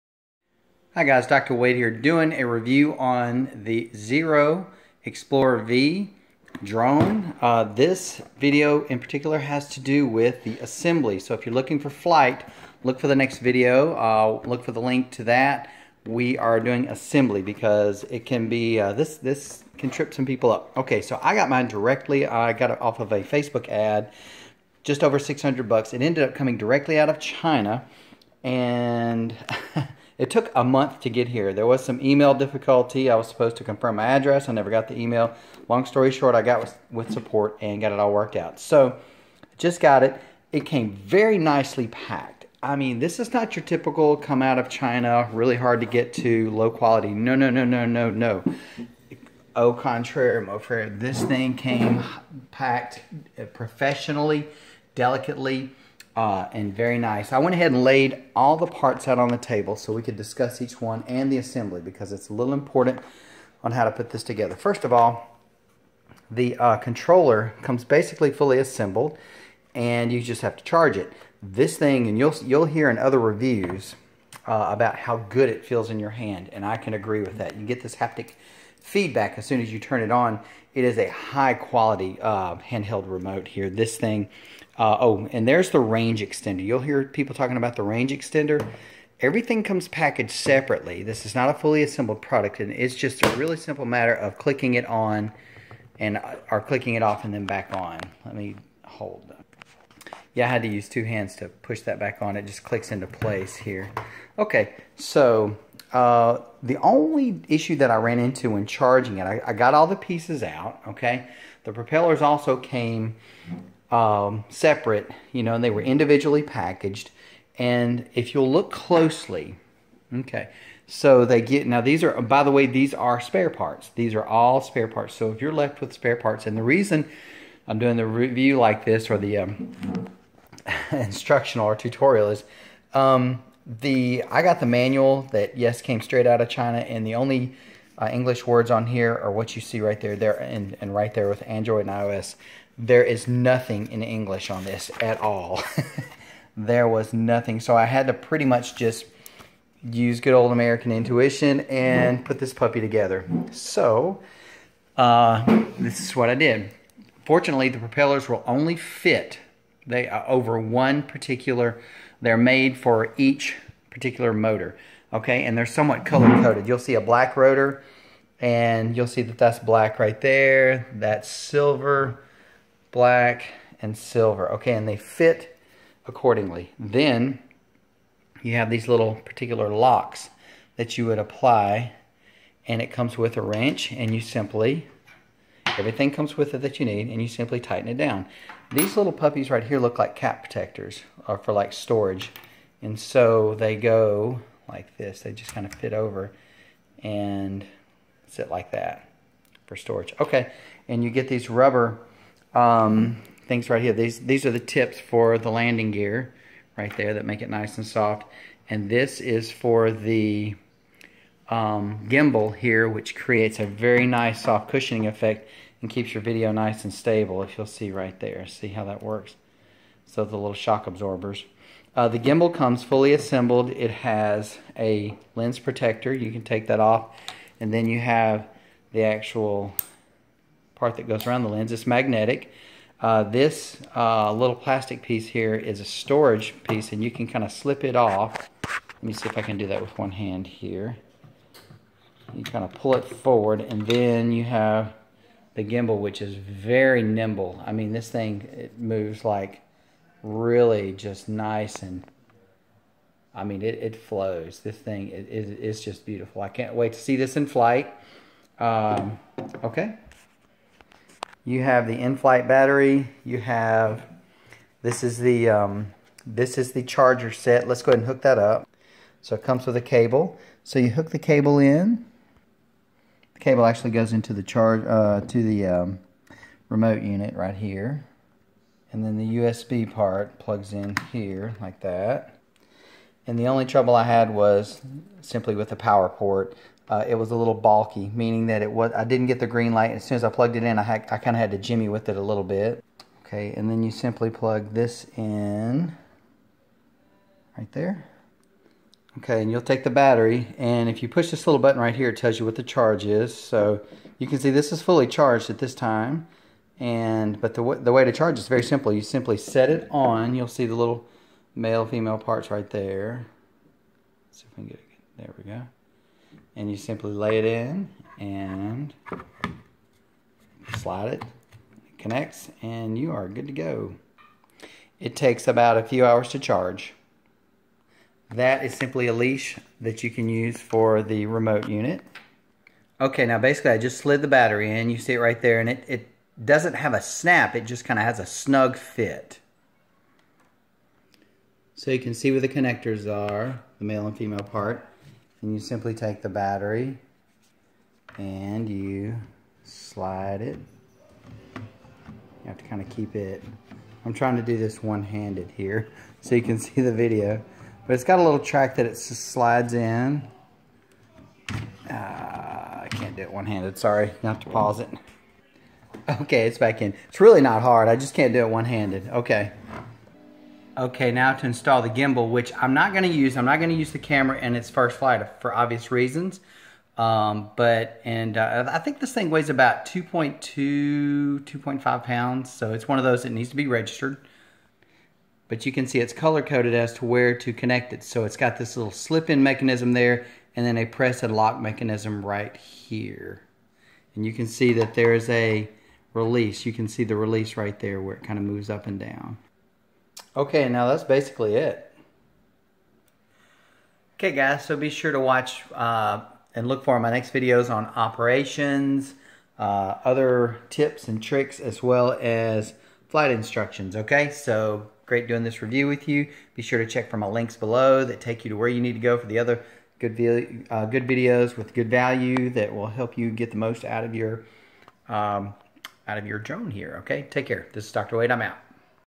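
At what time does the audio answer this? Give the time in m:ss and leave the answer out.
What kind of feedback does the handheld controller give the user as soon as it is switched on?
1:17.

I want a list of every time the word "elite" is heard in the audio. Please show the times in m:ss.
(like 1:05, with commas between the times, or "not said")
not said.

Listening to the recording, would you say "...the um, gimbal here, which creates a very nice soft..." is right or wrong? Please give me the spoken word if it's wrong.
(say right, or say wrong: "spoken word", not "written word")
right.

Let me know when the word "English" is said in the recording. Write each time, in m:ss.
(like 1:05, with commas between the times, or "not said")
2:18, 2:24.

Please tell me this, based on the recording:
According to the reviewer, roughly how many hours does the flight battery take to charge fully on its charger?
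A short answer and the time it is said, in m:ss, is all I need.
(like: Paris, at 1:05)
a few hours, at 5:25.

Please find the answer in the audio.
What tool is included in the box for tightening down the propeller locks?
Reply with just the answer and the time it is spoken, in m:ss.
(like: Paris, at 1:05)
a wrench, at 3:03.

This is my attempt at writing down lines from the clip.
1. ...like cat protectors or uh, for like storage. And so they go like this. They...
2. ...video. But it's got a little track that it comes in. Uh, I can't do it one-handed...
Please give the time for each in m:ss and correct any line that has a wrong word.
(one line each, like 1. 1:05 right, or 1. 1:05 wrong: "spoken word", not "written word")
1. 3:09 right
2. 5:56 wrong: "slides", not "comes".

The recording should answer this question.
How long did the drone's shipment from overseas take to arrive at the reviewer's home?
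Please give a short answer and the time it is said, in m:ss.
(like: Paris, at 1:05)
a month, at 0:30.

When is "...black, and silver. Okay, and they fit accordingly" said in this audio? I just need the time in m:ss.
2:52.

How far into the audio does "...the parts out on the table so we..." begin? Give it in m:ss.
0:58.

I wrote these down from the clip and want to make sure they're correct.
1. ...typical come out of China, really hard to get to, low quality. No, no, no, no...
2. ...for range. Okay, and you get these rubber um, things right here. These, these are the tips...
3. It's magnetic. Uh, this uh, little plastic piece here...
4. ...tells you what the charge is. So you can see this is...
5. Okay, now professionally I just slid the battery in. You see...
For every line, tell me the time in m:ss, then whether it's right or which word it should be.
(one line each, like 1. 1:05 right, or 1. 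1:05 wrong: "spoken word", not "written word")
1. 0:43 right
2. 3:19 wrong: "storage", not "range"
3. 3:51 right
4. 5:02 right
5. 5:32 wrong: "basically", not "professionally".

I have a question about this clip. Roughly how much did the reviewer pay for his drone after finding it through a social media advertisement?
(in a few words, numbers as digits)
just over 600 bucks.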